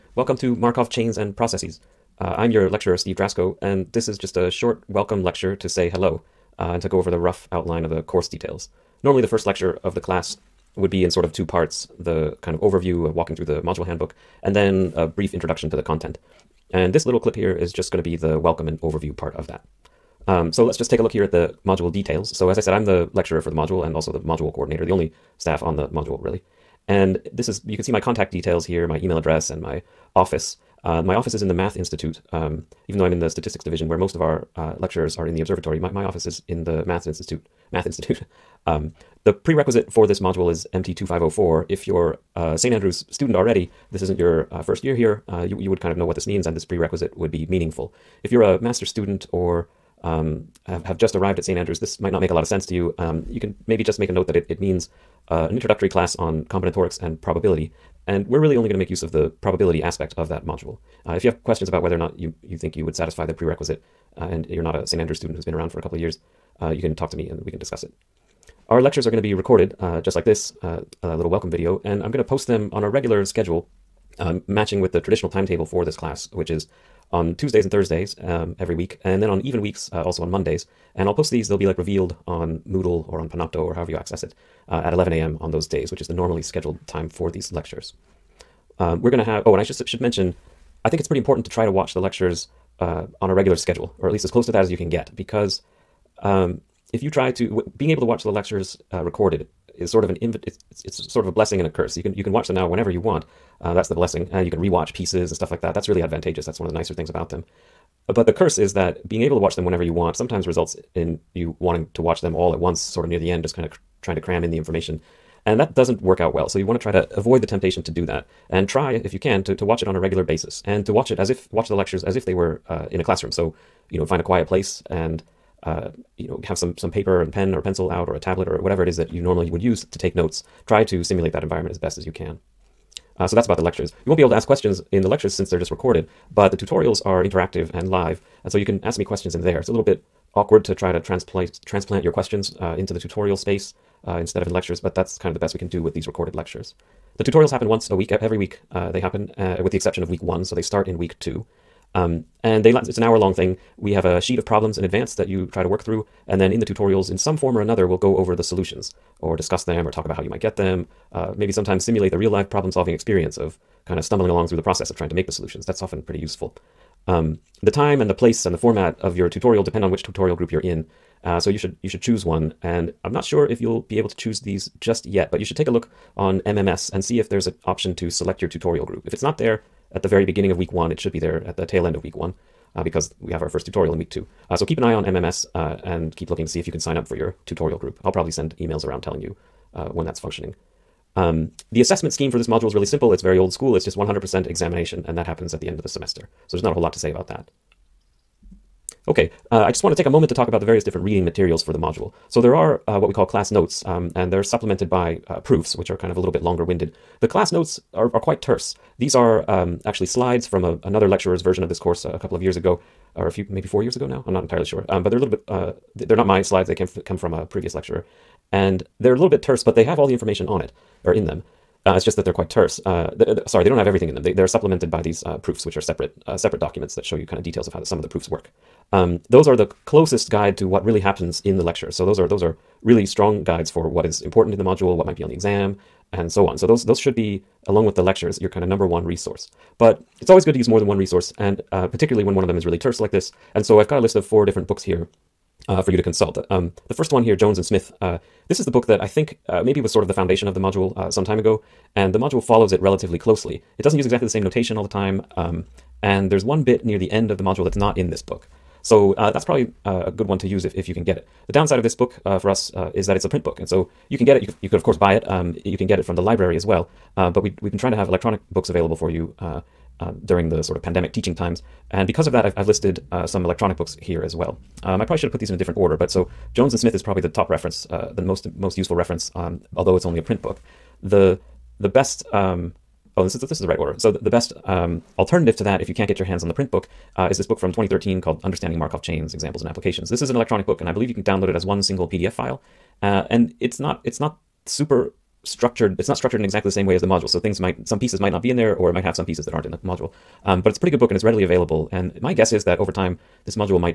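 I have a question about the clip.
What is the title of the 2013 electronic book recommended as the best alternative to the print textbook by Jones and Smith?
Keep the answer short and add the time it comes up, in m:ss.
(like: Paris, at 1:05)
Understanding Markov Chains, at 4:48.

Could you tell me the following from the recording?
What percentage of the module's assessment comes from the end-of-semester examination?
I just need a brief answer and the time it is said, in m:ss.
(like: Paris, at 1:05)
100%, at 3:13.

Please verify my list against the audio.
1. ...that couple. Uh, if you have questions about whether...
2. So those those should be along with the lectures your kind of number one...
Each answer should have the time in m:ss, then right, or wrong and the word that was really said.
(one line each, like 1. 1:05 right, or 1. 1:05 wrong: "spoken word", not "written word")
1. 1:00 wrong: "module", not "couple"
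2. 3:56 right.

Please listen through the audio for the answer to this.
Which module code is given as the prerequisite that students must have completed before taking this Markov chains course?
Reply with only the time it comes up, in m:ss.
0:40.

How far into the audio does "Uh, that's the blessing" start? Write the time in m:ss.
1:43.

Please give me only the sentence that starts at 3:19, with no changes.
Okay, uh, I just want to take a moment to talk about the various different reading materials for the module.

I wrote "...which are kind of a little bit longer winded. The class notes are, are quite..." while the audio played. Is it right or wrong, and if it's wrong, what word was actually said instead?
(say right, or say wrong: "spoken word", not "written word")
right.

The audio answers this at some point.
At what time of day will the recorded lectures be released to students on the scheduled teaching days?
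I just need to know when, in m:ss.
1:24.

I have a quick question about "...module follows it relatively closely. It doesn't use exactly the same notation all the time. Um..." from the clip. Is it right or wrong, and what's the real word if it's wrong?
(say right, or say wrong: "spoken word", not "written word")
right.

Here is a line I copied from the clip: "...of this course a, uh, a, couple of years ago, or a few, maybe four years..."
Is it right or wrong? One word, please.
right.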